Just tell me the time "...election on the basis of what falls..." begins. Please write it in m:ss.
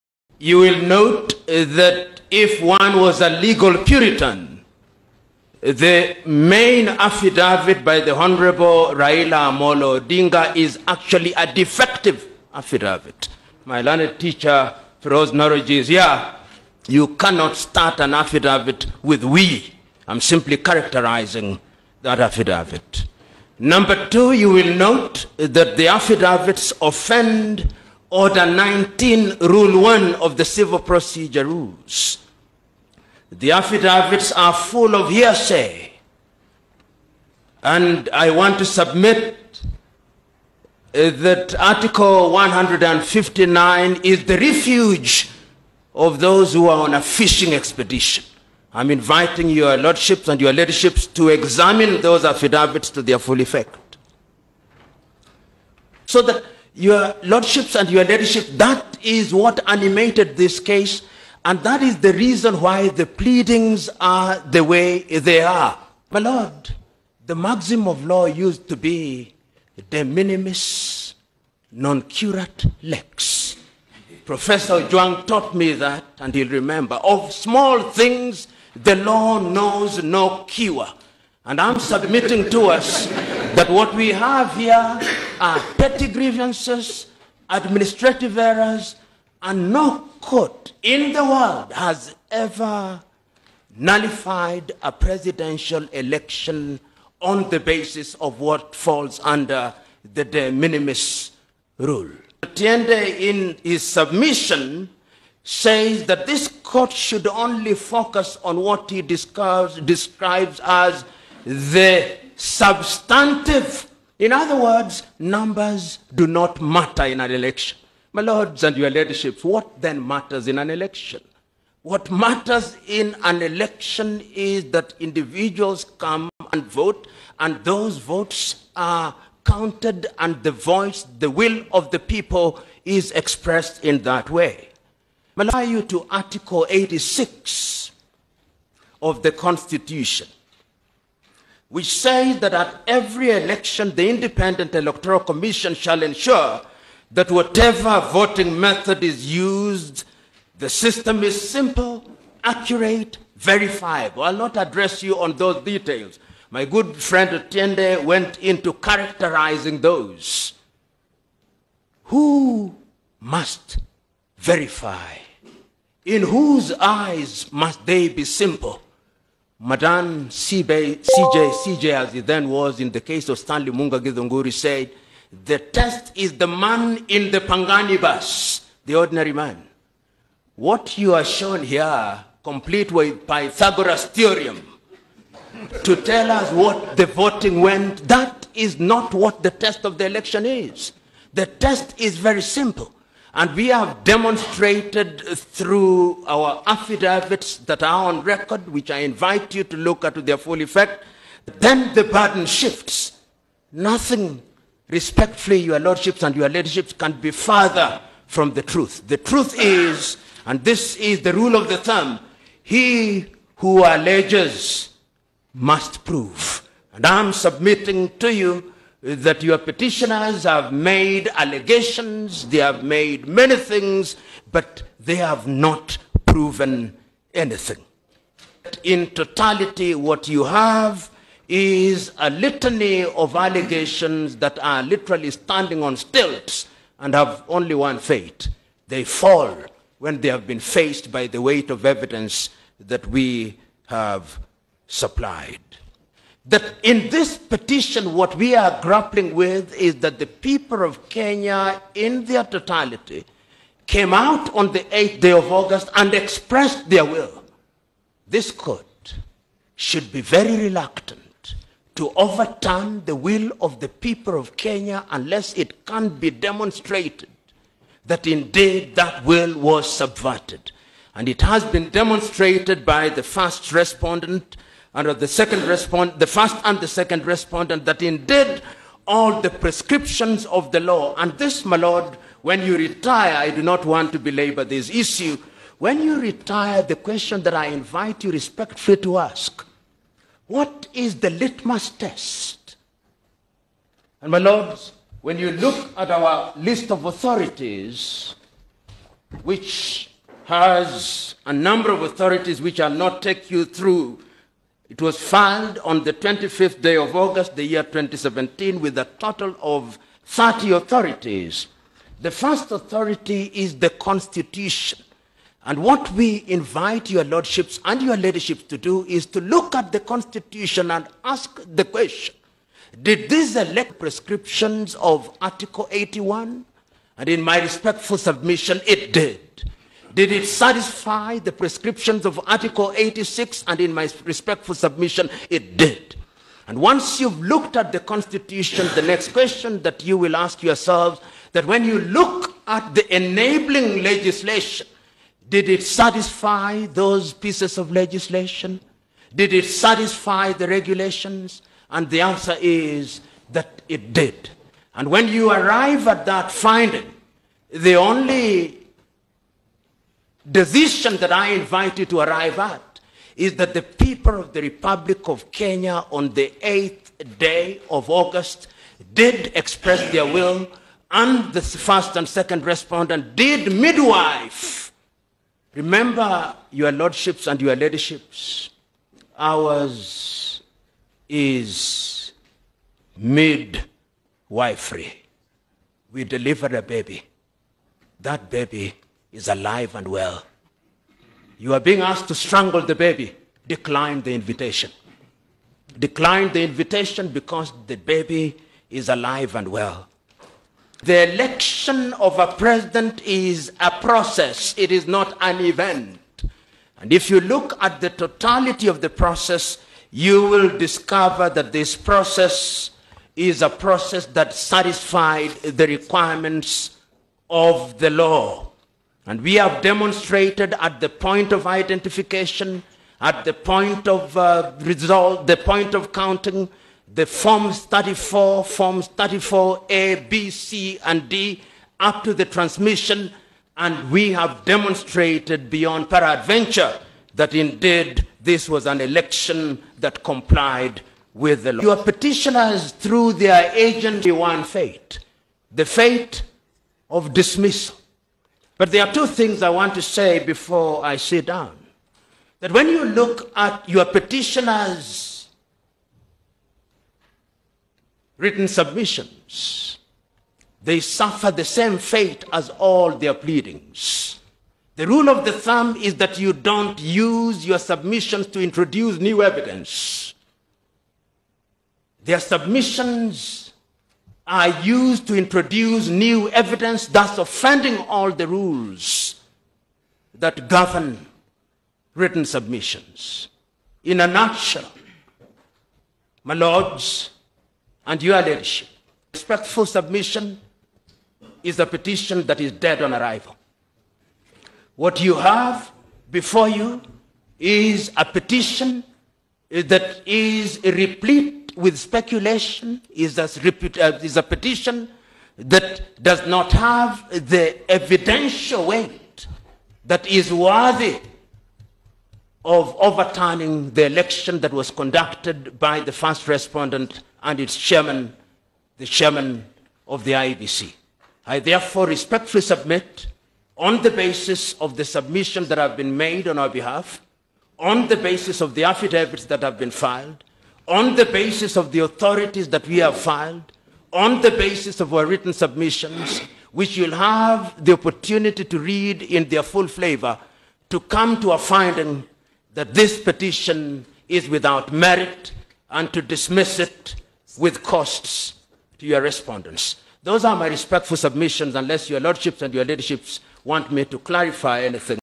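1:35.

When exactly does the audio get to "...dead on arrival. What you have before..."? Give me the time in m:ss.
8:12.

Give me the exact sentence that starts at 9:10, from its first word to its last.
Those are my respectful submissions, unless your lordships and your ladyship want me to clarify anything.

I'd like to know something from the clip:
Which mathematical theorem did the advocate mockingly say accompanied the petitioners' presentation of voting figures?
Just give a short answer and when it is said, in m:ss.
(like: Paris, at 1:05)
Pythagoras' theorem, at 3:03.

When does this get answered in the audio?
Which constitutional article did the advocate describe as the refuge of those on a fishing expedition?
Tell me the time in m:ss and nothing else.
0:41.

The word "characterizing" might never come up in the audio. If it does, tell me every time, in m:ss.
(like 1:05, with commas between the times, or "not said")
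0:20, 2:38.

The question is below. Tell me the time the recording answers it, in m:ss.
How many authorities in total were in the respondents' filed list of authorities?
5:10.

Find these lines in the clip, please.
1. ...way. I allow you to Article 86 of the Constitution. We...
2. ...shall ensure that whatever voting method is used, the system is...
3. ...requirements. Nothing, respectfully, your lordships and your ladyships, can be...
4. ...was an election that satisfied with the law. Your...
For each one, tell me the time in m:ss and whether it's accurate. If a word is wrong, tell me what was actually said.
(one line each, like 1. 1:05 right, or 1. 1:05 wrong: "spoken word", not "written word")
1. 2:14 right
2. 2:25 right
3. 3:22 wrong: "shifts", not "requirements"
4. 7:18 wrong: "complied", not "satisfied".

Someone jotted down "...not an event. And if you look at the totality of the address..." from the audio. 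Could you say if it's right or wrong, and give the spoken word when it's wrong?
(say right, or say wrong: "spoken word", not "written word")
wrong: "process", not "address".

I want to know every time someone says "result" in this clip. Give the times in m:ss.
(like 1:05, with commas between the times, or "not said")
7:04.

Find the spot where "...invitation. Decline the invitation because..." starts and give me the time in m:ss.
6:34.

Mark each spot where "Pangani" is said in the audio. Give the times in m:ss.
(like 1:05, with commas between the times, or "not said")
2:57.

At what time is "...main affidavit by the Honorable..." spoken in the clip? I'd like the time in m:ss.
0:06.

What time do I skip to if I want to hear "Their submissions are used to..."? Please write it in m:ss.
7:52.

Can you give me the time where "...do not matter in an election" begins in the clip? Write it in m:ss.
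1:56.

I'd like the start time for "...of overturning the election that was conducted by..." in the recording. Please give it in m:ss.
8:32.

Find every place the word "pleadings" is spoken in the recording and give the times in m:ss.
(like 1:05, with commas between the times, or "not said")
1:03, 7:43.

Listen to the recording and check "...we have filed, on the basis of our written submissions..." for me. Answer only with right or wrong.
right.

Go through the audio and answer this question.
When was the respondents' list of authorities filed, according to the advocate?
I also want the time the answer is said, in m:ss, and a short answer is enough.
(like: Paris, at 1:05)
25 August 2017, at 5:06.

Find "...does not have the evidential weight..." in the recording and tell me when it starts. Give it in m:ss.
8:26.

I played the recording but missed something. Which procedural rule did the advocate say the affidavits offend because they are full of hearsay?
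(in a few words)
Order 19, Rule 1.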